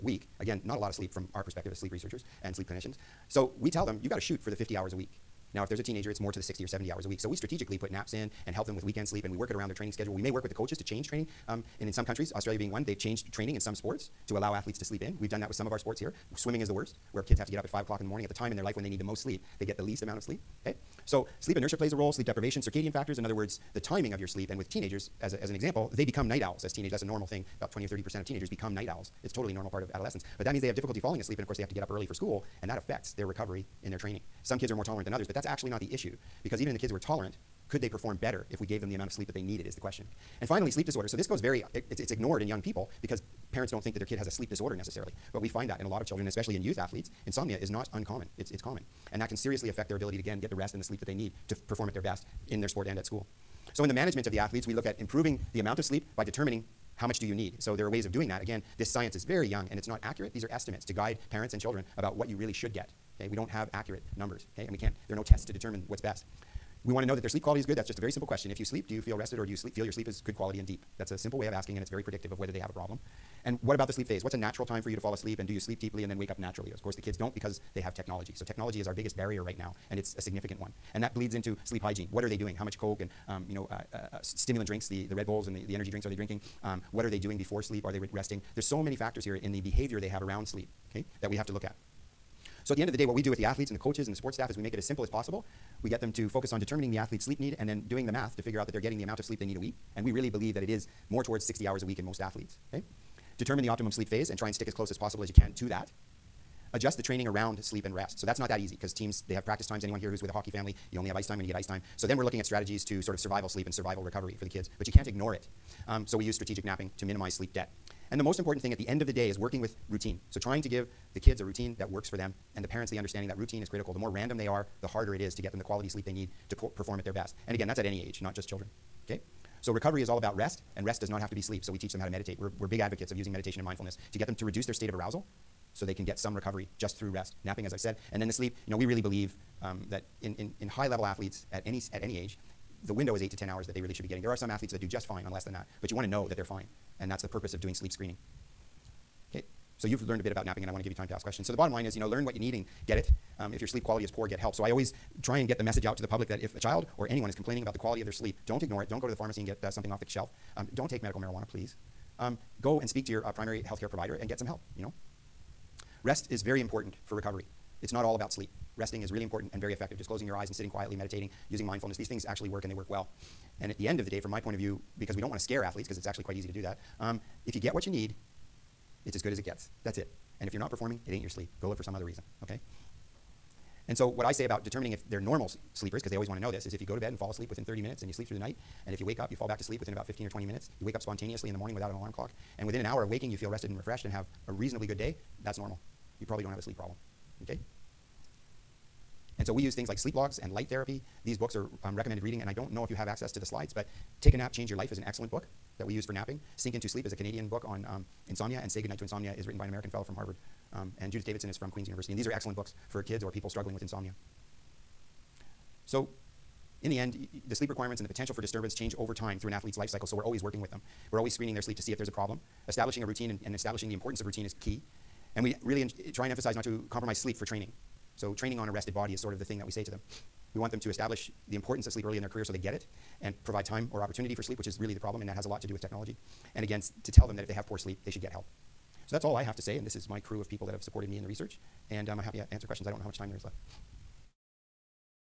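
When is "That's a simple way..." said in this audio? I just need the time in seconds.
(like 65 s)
70 s.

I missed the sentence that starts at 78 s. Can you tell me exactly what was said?
So, technology is our biggest barrier right now, and it's a significant one.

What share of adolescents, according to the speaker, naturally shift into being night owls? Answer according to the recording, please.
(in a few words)
20 or 30%.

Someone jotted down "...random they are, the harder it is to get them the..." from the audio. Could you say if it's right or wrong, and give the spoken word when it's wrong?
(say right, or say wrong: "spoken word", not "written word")
right.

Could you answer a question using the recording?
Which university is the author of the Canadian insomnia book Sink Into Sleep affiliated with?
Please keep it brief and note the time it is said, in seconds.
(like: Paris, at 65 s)
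Queen's University, at 211 s.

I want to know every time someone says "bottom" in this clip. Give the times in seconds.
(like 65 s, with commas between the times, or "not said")
151 s.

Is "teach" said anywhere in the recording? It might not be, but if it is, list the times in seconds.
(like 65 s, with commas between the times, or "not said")
131 s.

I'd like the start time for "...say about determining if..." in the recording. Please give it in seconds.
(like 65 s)
184 s.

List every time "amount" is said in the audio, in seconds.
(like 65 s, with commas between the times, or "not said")
20 s, 38 s, 55 s, 99 s.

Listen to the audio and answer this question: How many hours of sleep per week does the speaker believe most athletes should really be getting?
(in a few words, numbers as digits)
60 hours.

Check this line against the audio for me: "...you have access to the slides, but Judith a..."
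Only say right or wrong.
wrong.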